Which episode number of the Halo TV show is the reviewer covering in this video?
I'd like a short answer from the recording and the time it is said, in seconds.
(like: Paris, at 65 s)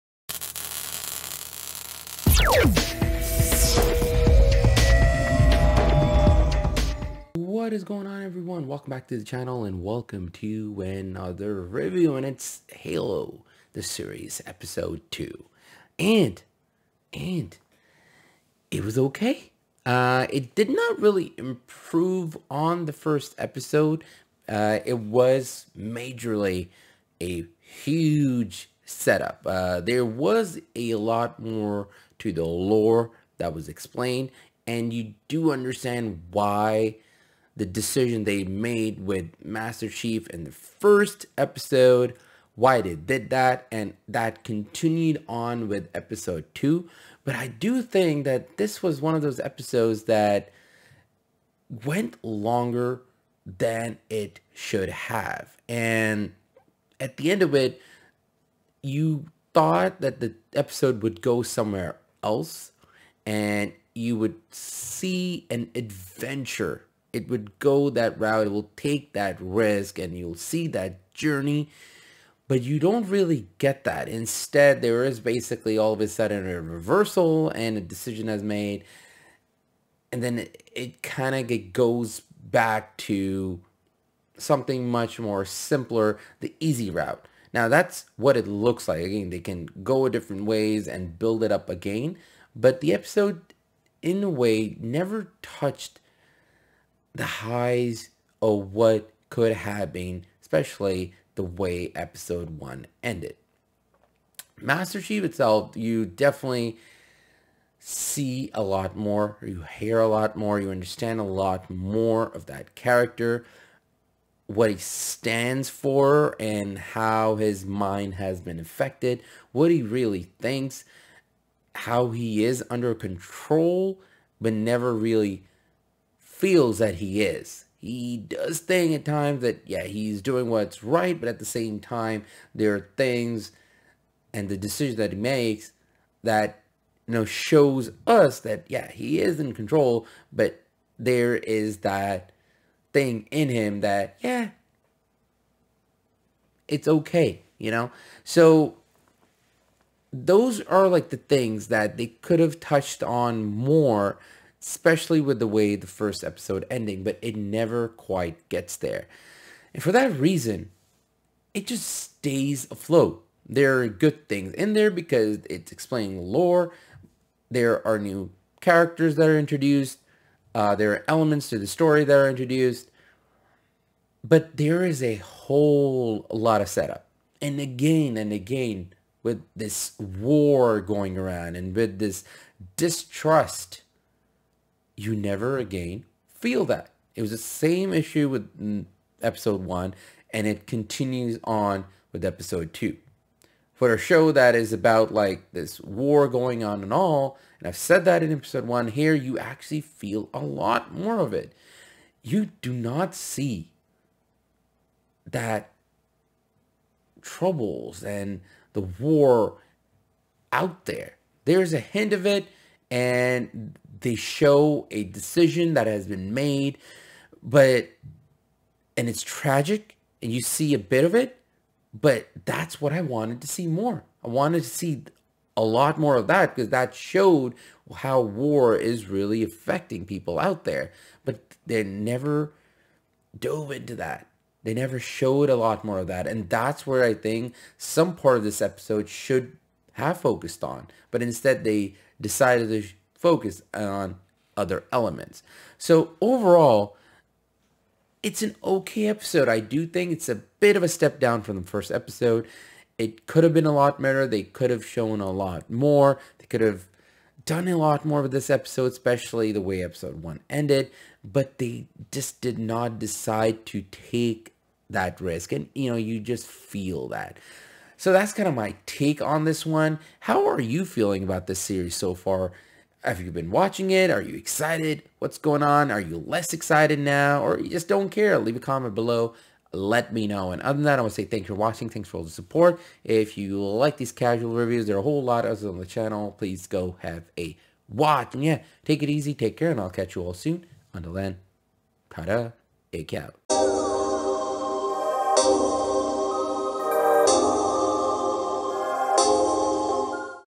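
2, at 14 s.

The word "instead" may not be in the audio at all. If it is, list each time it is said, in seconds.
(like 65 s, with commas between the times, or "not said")
74 s, 241 s.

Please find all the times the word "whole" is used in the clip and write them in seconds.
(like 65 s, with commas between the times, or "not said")
175 s, 285 s.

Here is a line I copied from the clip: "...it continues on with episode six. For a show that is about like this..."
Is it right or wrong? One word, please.
wrong.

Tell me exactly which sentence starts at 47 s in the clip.
But I do think that this was one of those episodes that went longer than it should have.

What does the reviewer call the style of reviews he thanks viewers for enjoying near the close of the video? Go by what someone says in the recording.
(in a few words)
casual reviews.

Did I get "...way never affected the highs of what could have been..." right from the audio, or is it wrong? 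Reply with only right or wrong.
wrong.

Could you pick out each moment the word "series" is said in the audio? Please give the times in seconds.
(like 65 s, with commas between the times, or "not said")
13 s, 271 s.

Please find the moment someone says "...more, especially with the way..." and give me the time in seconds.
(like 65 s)
153 s.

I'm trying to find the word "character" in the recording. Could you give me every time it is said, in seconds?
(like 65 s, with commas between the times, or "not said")
112 s, 168 s.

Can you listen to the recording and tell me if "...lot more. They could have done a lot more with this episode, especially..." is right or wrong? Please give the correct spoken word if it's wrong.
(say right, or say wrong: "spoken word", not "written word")
right.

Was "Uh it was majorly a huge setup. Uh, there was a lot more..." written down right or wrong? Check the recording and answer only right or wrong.
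right.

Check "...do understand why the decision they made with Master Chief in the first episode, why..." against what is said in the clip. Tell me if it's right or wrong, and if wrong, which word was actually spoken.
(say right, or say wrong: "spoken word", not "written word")
right.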